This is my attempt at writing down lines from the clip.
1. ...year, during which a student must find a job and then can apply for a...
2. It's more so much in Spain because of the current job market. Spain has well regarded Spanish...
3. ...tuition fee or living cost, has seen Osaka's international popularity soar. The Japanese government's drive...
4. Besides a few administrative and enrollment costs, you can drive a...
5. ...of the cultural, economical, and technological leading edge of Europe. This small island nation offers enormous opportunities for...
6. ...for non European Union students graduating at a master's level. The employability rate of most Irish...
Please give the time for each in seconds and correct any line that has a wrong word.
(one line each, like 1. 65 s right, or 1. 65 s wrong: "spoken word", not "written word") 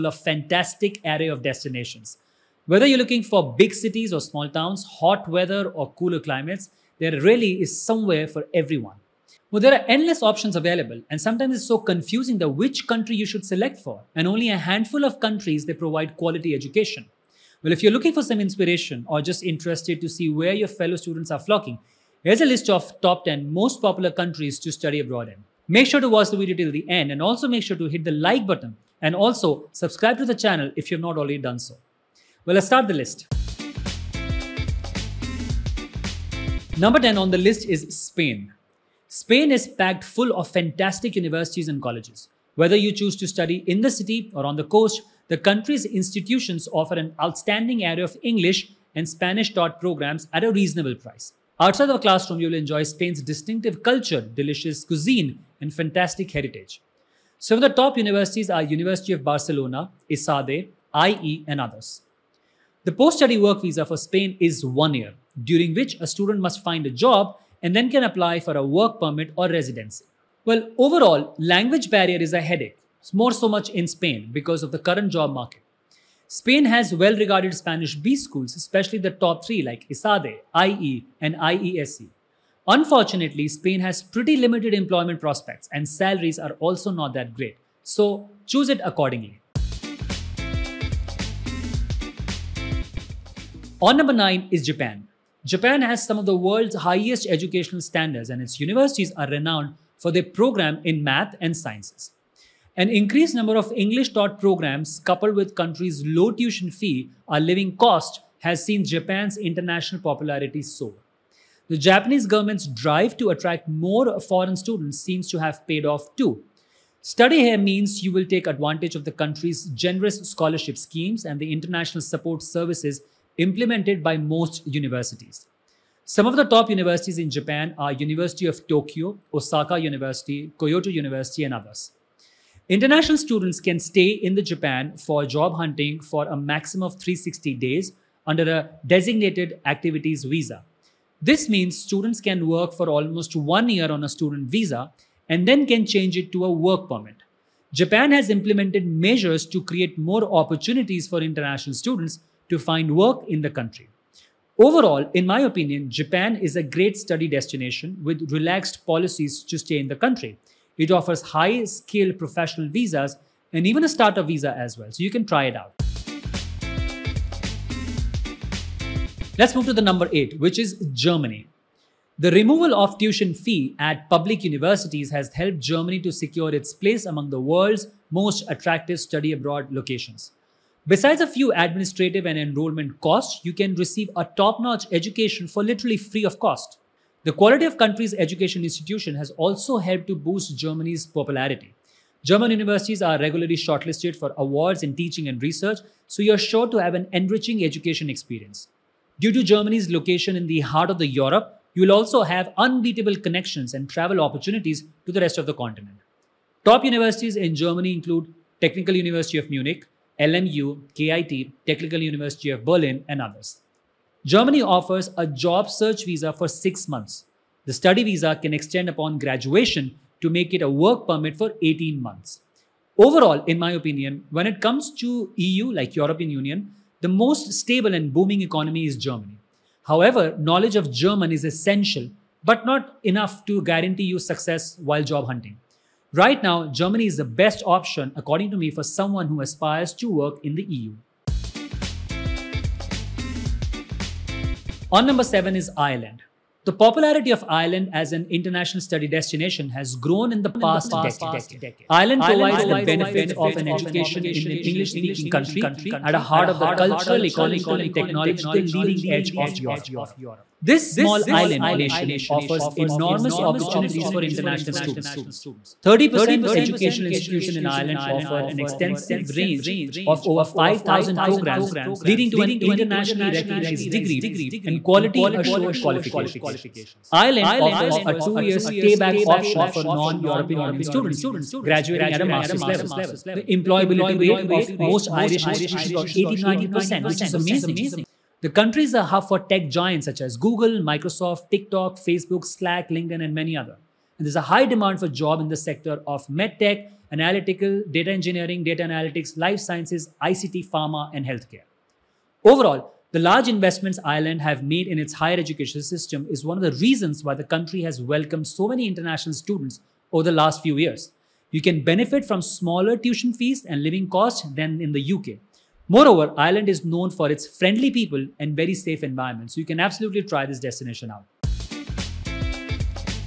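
1. 64 s right
2. 73 s right
3. 106 s wrong: "Japan", not "Osaka"
4. 180 s wrong: "receive", not "drive"
5. 256 s right
6. 279 s right.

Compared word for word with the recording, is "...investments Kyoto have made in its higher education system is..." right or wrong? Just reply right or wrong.
wrong.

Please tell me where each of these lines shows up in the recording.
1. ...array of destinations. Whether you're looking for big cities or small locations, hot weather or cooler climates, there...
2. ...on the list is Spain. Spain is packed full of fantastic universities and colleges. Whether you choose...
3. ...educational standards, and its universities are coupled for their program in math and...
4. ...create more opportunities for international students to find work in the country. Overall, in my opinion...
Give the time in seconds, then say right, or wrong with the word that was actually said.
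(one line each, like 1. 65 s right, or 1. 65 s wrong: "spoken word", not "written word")
1. 1 s wrong: "towns", not "locations"
2. 37 s right
3. 97 s wrong: "renowned", not "coupled"
4. 149 s right.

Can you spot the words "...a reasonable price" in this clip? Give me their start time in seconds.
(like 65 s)
50 s.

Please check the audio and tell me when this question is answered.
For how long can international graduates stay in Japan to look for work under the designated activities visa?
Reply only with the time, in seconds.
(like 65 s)
136 s.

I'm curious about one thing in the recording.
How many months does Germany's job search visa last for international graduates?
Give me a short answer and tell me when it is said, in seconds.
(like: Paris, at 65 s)
6 months, at 216 s.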